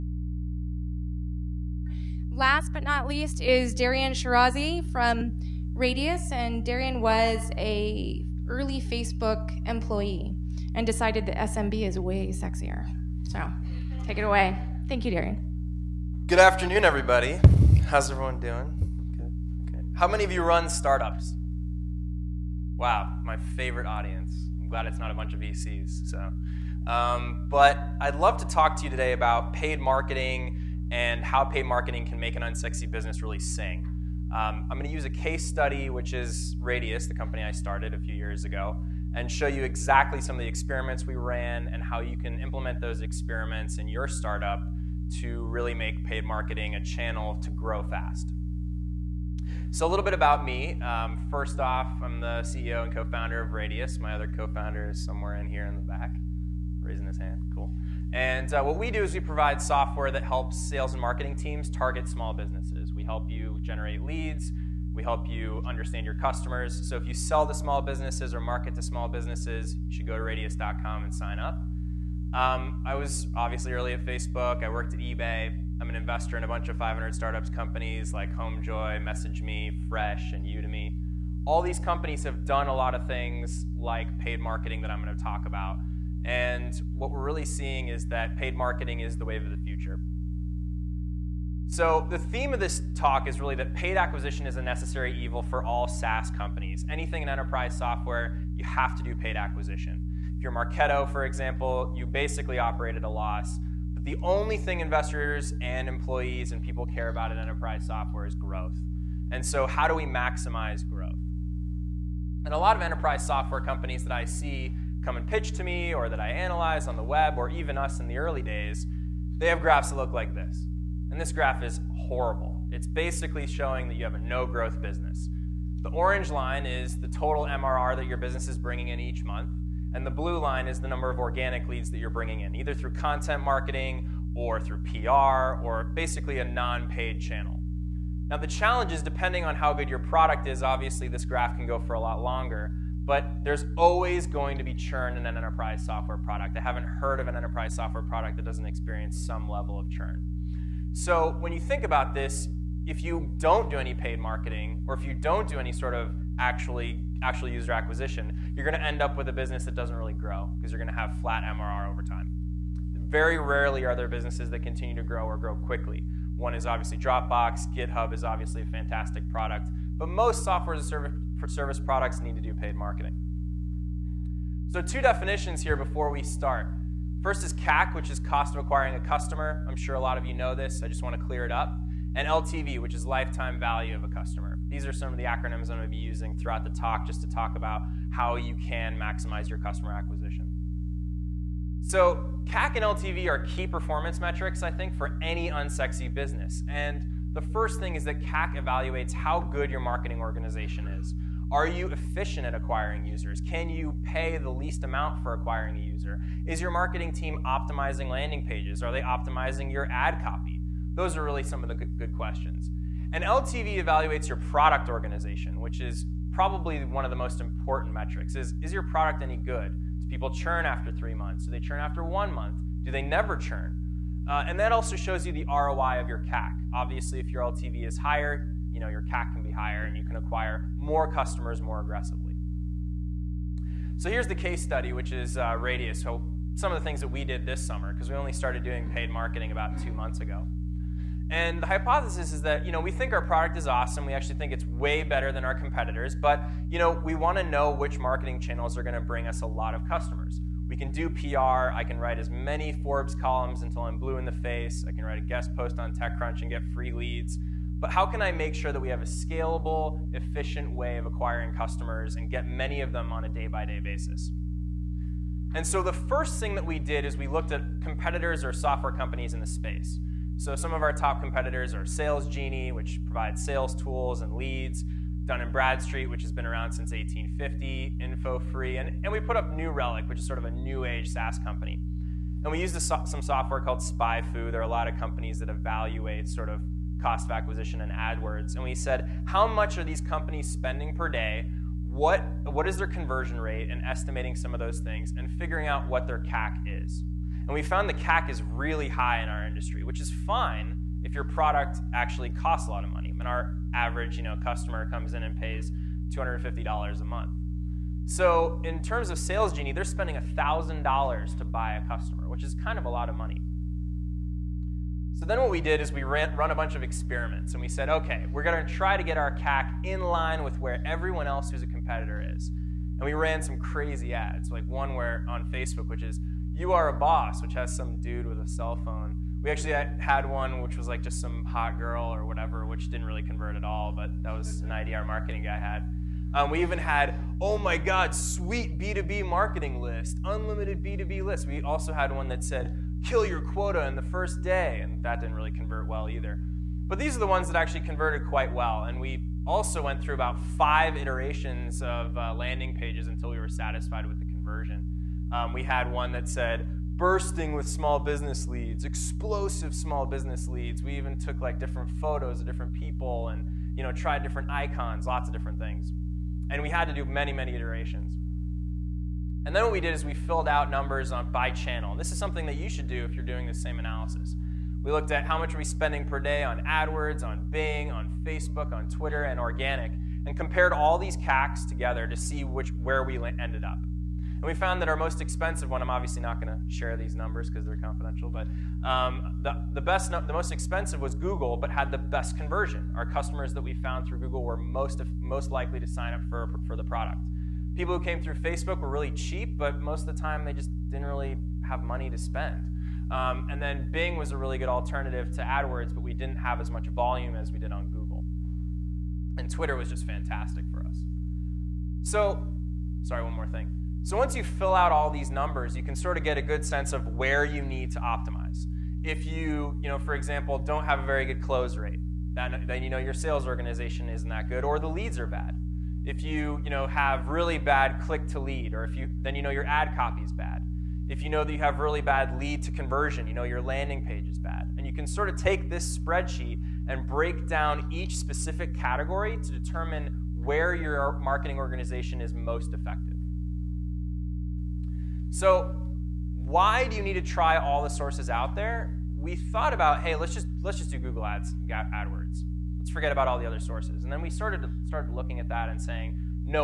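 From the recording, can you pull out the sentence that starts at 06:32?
Our customers that we found through Google were most, most likely to sign up for, for the product.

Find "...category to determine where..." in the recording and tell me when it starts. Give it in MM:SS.
07:18.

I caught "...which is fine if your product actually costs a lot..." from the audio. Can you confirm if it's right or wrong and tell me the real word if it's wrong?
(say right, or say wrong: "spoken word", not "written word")
right.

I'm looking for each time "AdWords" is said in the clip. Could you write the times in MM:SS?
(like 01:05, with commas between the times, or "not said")
04:47, 06:16, 06:45, 07:31.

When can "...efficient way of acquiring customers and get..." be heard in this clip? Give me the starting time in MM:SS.
04:20.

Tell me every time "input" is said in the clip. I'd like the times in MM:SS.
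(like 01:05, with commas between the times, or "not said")
not said.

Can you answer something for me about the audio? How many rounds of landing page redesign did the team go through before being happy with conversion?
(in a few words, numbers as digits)
5.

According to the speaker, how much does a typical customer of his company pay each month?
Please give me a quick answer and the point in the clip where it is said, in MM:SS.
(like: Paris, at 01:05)
$250, at 05:06.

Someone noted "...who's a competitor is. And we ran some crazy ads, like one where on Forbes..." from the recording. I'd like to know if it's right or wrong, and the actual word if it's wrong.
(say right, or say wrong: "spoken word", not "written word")
wrong: "Facebook", not "Forbes".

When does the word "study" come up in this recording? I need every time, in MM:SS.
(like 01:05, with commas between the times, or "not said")
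00:35, 03:54.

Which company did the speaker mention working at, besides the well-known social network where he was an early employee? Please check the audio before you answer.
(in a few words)
eBay.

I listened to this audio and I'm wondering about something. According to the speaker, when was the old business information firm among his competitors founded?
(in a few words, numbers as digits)
1850.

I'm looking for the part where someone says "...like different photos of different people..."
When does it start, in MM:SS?
06:01.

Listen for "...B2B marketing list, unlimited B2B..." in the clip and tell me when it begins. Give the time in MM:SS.
05:38.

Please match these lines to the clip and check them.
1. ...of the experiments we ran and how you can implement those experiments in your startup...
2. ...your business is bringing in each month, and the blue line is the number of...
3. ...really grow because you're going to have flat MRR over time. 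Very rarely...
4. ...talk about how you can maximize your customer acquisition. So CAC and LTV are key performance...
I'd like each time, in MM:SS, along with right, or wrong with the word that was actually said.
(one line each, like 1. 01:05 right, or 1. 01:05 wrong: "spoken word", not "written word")
1. 00:40 right
2. 02:08 right
3. 02:39 right
4. 03:07 right.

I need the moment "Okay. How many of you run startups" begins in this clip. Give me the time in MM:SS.
00:19.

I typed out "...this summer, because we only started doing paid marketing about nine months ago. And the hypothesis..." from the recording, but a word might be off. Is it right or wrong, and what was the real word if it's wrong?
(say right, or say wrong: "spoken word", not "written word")
wrong: "two", not "nine".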